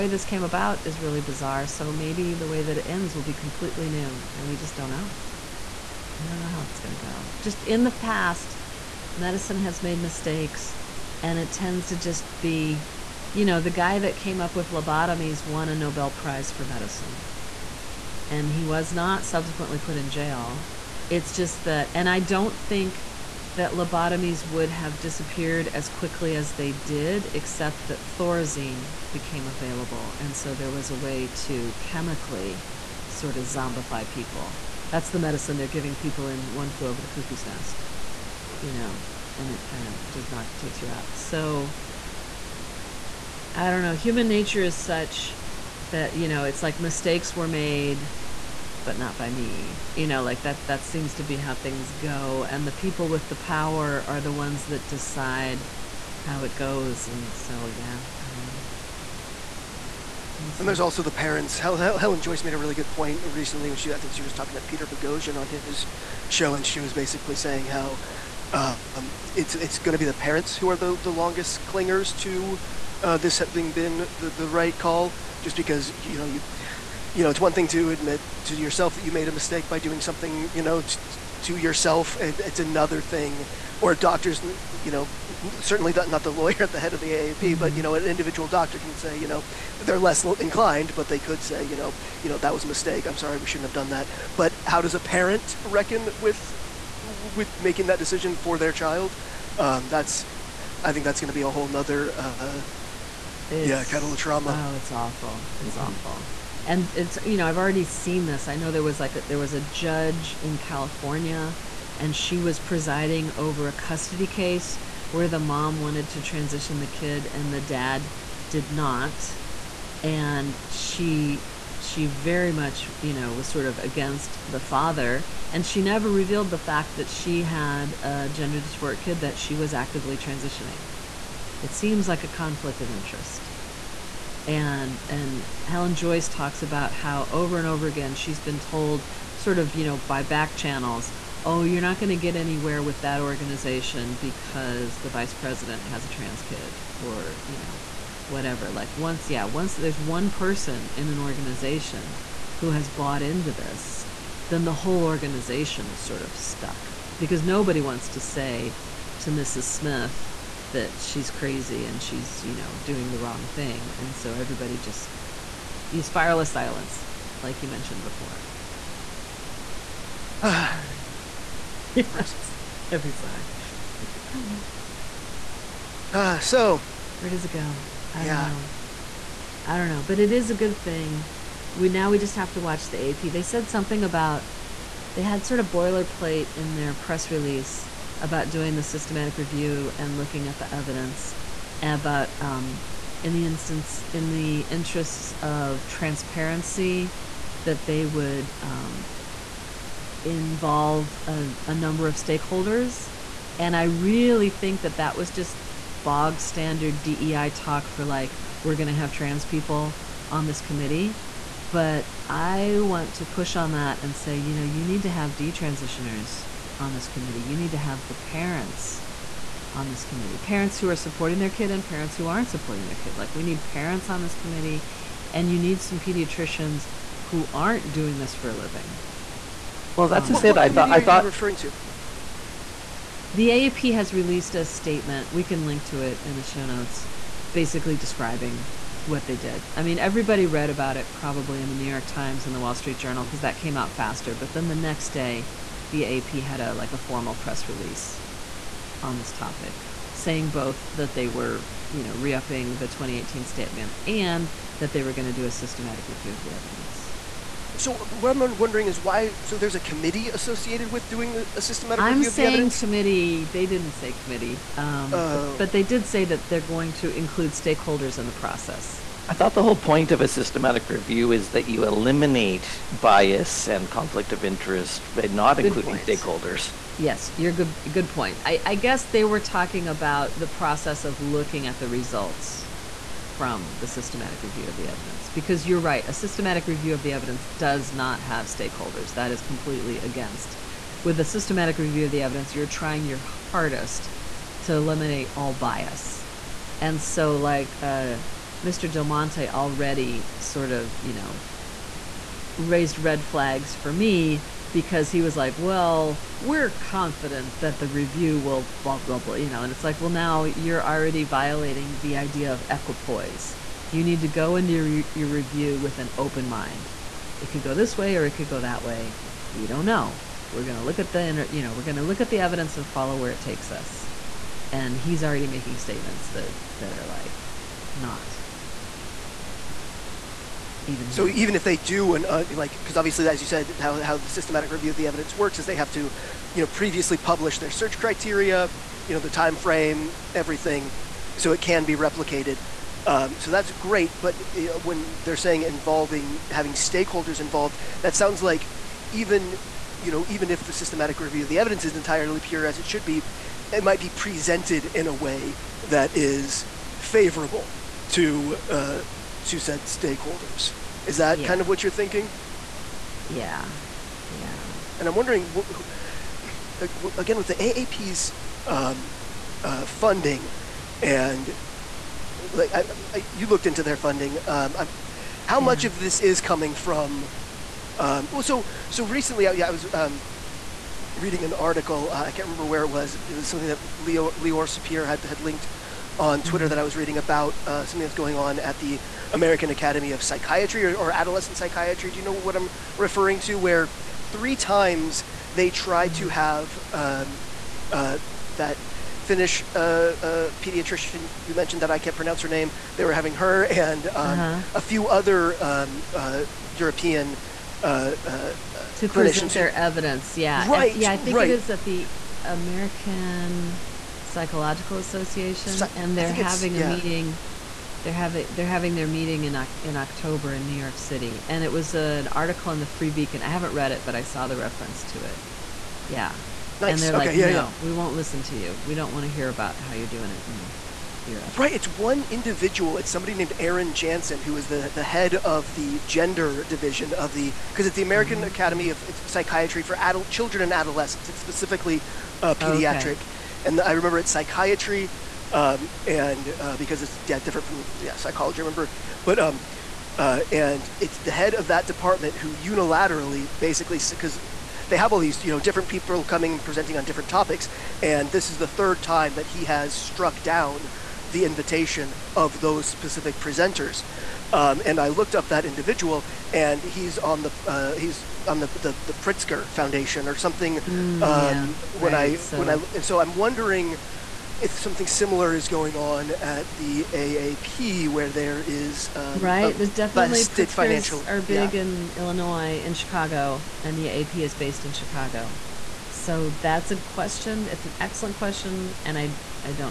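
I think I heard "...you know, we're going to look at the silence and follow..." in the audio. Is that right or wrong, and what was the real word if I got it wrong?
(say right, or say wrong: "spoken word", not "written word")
wrong: "evidence", not "silence".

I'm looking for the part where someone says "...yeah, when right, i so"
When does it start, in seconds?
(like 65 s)
471 s.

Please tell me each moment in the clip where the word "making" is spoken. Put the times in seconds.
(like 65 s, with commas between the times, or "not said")
97 s, 325 s.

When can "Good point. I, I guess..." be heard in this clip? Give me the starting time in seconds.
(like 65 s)
277 s.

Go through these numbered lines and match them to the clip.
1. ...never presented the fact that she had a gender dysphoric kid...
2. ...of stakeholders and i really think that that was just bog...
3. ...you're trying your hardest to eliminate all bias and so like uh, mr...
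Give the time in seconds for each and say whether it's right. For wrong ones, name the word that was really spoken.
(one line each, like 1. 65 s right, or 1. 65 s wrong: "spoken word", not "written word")
1. 125 s wrong: "revealed", not "presented"
2. 202 s right
3. 292 s right.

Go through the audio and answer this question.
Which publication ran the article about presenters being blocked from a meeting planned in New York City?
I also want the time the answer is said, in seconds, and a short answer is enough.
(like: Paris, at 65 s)
Free Beacon, at 422 s.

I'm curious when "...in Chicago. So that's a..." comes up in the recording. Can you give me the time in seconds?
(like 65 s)
484 s.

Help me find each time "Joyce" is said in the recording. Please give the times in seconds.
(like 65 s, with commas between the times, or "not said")
62 s, 135 s.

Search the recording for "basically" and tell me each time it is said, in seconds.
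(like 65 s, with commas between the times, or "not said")
66 s, 237 s, 453 s.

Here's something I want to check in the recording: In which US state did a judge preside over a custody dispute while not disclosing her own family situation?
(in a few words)
California.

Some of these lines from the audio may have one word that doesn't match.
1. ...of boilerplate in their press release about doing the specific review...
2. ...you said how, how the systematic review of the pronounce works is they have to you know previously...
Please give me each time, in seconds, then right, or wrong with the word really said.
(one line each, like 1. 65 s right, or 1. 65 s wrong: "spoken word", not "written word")
1. 185 s wrong: "systematic", not "specific"
2. 333 s wrong: "evidence", not "pronounce".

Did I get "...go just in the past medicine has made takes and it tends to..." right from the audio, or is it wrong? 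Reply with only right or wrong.
wrong.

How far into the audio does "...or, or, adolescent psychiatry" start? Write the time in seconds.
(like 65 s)
390 s.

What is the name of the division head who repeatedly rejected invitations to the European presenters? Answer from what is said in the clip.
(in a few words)
Aron Janssen.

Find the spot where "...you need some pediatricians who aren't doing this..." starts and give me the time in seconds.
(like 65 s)
225 s.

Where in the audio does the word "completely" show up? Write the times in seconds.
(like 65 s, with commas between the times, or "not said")
3 s, 289 s.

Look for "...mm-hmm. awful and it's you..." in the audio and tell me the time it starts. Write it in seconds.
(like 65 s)
105 s.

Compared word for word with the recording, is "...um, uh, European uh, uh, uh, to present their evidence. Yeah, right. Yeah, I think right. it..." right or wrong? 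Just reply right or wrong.
right.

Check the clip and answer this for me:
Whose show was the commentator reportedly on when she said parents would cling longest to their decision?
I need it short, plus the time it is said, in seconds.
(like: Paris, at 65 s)
Peter Boghossian, at 64 s.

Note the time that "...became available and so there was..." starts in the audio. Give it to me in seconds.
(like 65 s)
29 s.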